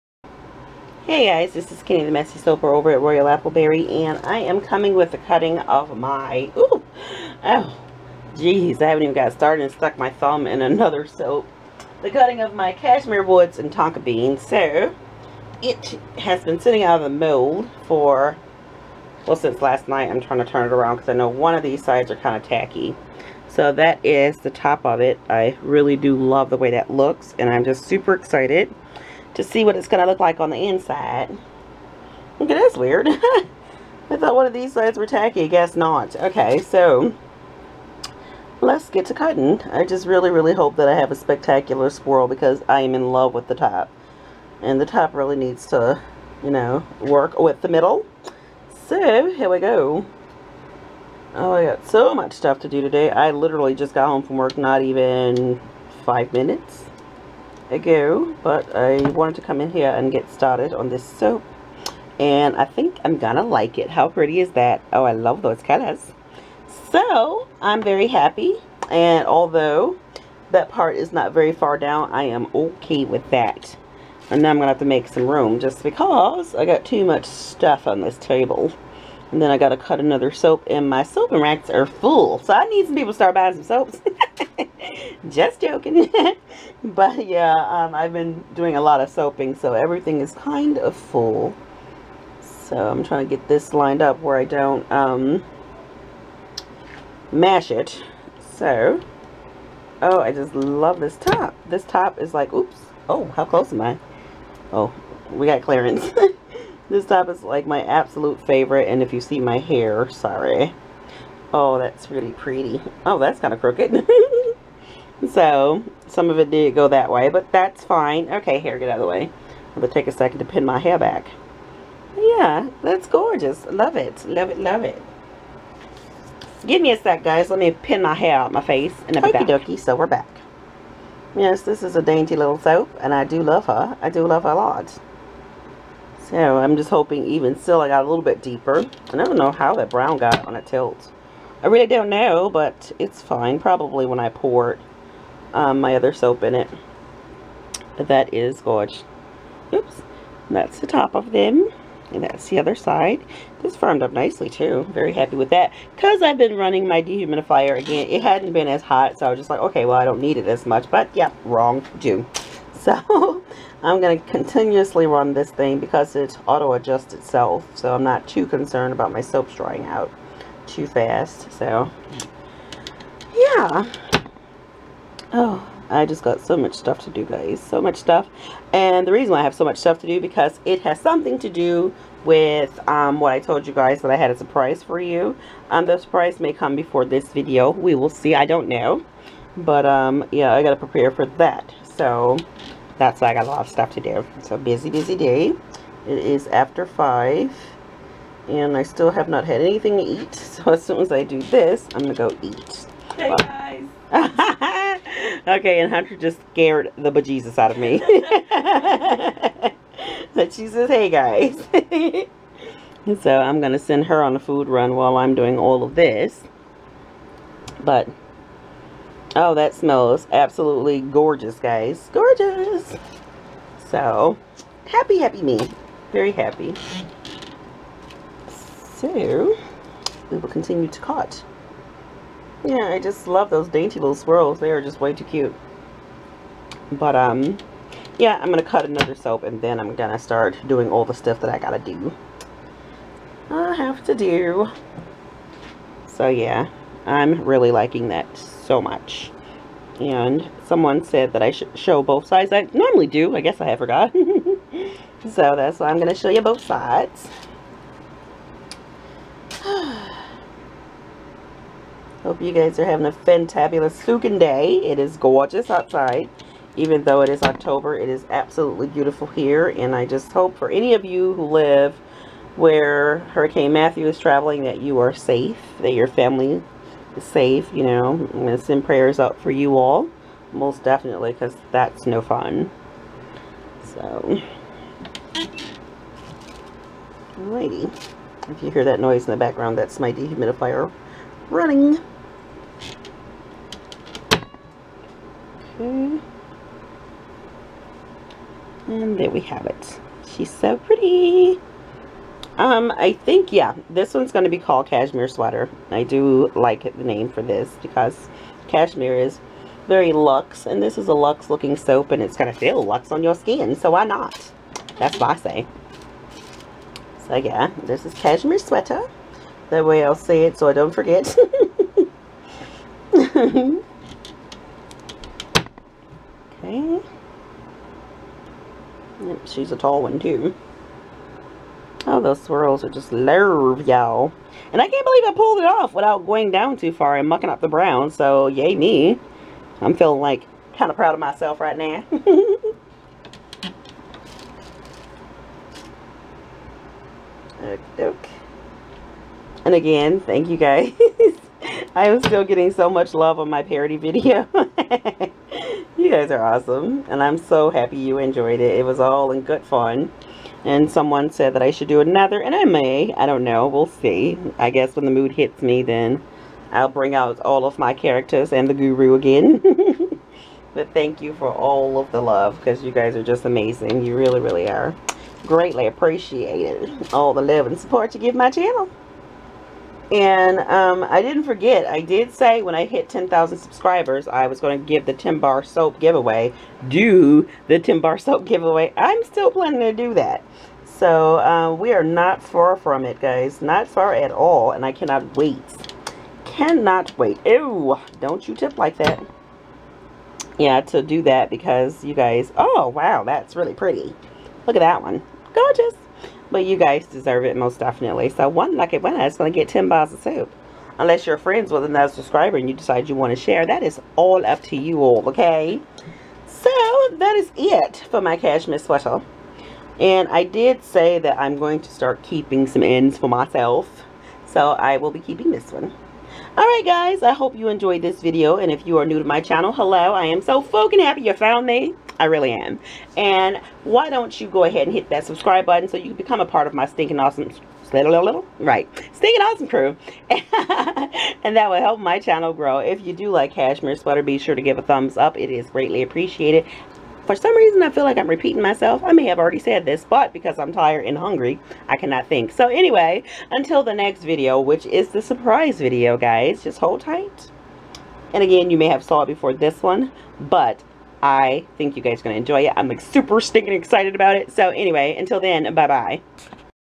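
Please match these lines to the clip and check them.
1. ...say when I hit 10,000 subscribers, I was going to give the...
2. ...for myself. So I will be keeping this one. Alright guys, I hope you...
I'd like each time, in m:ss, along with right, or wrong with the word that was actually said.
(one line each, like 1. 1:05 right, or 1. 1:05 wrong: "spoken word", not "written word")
1. 6:22 right
2. 7:03 right.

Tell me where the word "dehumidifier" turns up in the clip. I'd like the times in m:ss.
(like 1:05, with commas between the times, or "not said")
2:37, 4:50.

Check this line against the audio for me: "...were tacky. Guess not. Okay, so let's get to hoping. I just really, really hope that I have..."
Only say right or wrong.
wrong.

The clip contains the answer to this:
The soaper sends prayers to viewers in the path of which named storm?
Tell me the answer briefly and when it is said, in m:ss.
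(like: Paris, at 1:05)
Hurricane Matthew, at 4:33.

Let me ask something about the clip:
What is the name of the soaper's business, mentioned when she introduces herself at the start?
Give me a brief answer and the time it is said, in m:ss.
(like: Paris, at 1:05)
Royal Appleberry, at 0:03.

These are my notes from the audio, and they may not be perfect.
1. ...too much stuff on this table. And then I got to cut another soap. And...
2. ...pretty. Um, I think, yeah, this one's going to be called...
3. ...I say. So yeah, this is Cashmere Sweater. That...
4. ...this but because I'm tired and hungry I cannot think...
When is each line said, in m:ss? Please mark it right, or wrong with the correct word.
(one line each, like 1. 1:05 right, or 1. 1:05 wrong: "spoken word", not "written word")
1. 1:16 right
2. 5:00 right
3. 5:15 right
4. 7:29 right.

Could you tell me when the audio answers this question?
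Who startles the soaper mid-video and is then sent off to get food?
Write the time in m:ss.
3:25.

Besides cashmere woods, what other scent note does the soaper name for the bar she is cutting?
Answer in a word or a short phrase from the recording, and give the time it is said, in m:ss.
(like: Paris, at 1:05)
tonka beans, at 0:13.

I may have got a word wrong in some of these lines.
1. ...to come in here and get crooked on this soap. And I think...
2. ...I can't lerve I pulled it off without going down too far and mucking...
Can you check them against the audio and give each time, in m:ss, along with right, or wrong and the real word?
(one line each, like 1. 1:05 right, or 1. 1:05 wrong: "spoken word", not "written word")
1. 0:59 wrong: "started", not "crooked"
2. 5:34 wrong: "believe", not "lerve".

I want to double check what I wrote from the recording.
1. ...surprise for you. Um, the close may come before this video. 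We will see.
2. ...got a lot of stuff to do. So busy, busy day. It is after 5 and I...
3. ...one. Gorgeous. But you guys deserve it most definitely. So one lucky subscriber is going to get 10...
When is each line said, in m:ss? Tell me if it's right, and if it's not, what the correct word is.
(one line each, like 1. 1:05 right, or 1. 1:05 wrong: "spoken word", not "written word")
1. 3:04 wrong: "surprise", not "close"
2. 3:13 right
3. 6:45 wrong: "winner", not "subscriber".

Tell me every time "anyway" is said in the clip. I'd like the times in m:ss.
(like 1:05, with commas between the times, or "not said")
7:32, 7:44.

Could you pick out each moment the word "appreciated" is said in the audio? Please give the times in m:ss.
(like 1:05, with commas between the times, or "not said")
6:15, 7:26.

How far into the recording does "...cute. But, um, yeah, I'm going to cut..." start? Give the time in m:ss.
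3:55.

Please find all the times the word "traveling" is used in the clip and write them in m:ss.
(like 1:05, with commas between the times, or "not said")
4:34.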